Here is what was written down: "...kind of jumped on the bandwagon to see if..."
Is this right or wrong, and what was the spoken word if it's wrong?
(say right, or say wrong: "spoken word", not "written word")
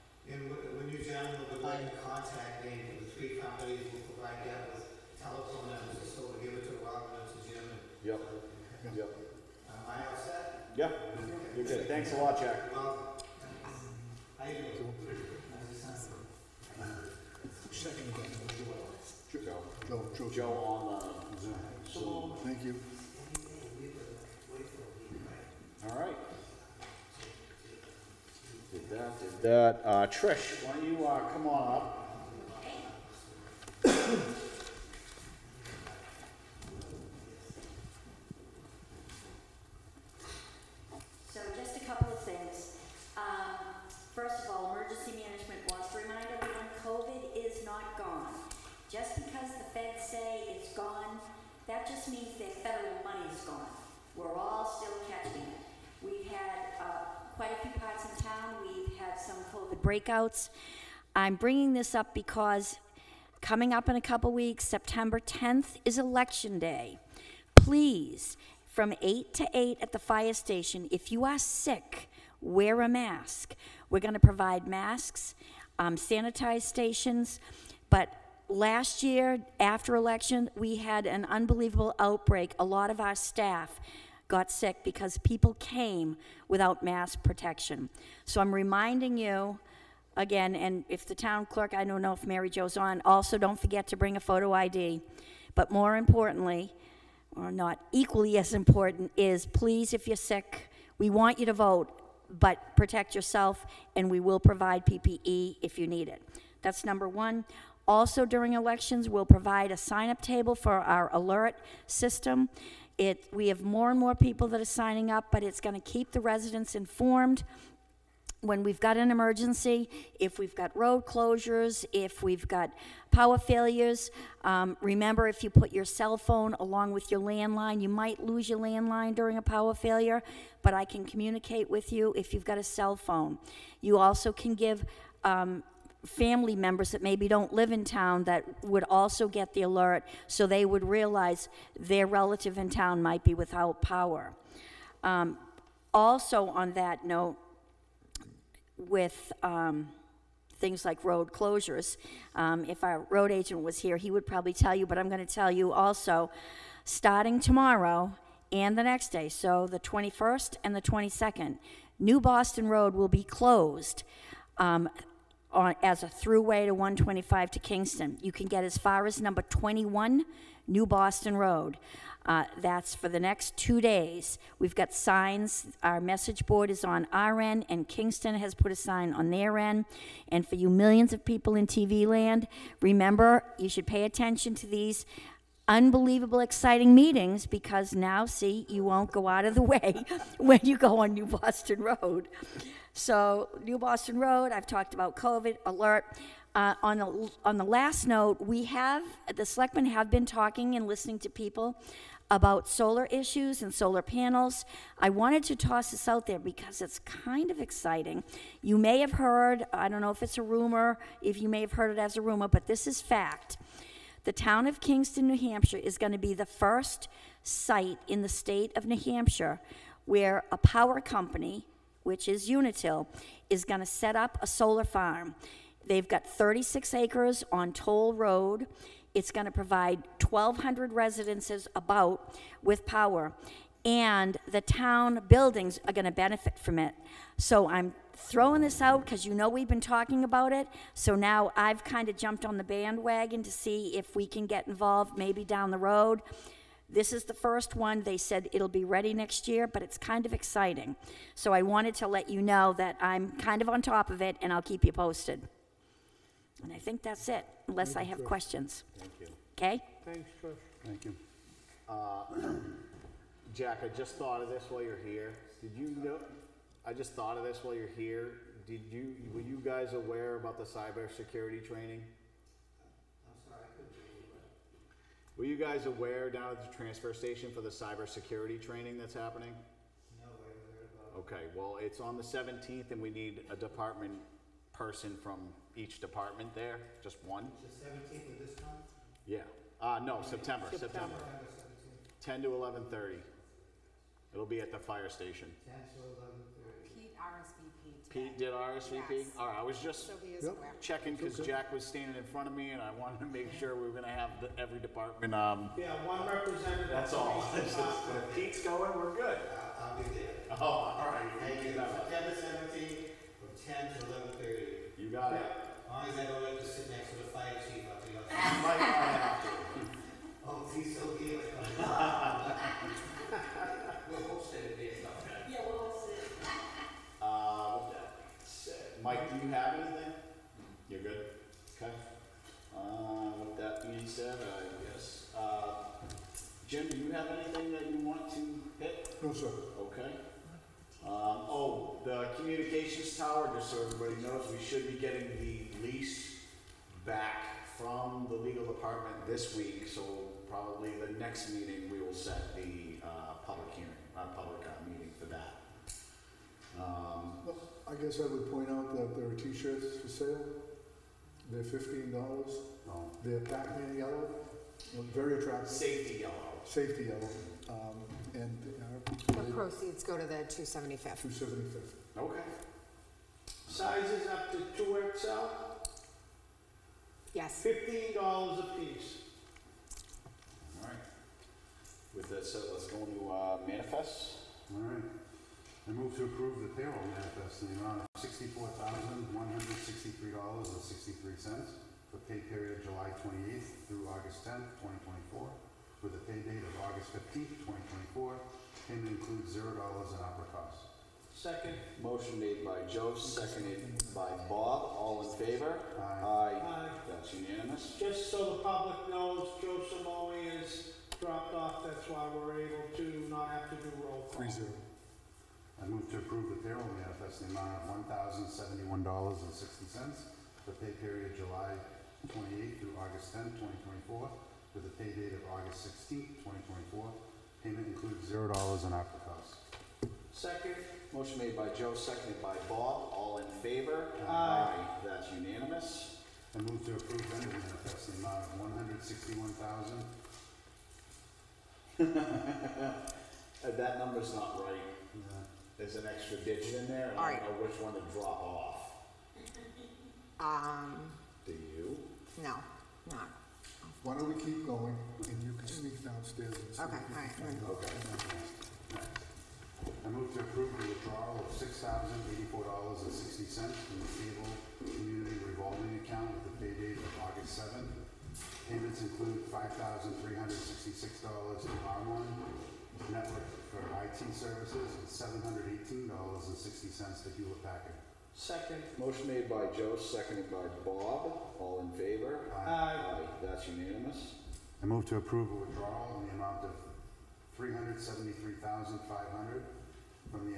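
right.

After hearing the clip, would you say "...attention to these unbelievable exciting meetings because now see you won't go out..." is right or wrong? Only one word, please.
right.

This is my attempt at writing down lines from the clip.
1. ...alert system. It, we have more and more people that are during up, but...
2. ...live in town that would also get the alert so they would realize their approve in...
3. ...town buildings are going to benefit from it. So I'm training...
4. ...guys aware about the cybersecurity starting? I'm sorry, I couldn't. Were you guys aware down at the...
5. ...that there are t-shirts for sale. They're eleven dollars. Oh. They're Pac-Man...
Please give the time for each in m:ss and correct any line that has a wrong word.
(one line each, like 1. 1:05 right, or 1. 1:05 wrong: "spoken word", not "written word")
1. 1:51 wrong: "signing", not "during"
2. 2:17 wrong: "relative", not "approve"
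3. 3:54 wrong: "throwing", not "training"
4. 4:29 wrong: "training", not "starting"
5. 5:58 wrong: "fifteen", not "eleven".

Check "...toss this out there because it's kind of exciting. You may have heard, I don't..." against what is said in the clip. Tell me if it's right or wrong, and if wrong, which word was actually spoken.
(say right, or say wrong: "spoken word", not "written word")
right.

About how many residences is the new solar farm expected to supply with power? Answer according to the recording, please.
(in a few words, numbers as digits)
1,200.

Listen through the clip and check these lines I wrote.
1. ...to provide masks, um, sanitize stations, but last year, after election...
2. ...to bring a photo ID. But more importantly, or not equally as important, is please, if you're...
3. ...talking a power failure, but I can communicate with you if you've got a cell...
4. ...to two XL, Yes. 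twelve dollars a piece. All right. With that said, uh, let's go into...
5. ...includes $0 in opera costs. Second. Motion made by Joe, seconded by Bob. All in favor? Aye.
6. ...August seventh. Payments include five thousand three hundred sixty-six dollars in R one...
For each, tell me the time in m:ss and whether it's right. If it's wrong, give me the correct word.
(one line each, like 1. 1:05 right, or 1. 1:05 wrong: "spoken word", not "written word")
1. 1:14 right
2. 1:33 right
3. 2:09 wrong: "during", not "talking"
4. 6:14 wrong: "fifteen", not "twelve"
5. 6:39 right
6. 7:47 right.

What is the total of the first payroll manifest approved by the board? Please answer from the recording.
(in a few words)
$64,163.63.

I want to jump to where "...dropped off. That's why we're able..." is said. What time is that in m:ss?
6:51.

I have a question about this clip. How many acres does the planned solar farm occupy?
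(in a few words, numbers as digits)
36.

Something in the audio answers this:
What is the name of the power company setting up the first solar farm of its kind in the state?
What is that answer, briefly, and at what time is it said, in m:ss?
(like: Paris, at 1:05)
Unitil, at 3:42.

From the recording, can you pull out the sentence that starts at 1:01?
I'm bringing this up because coming up in a couple weeks, September 10th is election day.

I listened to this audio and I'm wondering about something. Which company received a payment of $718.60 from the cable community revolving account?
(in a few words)
Hewlett Packard.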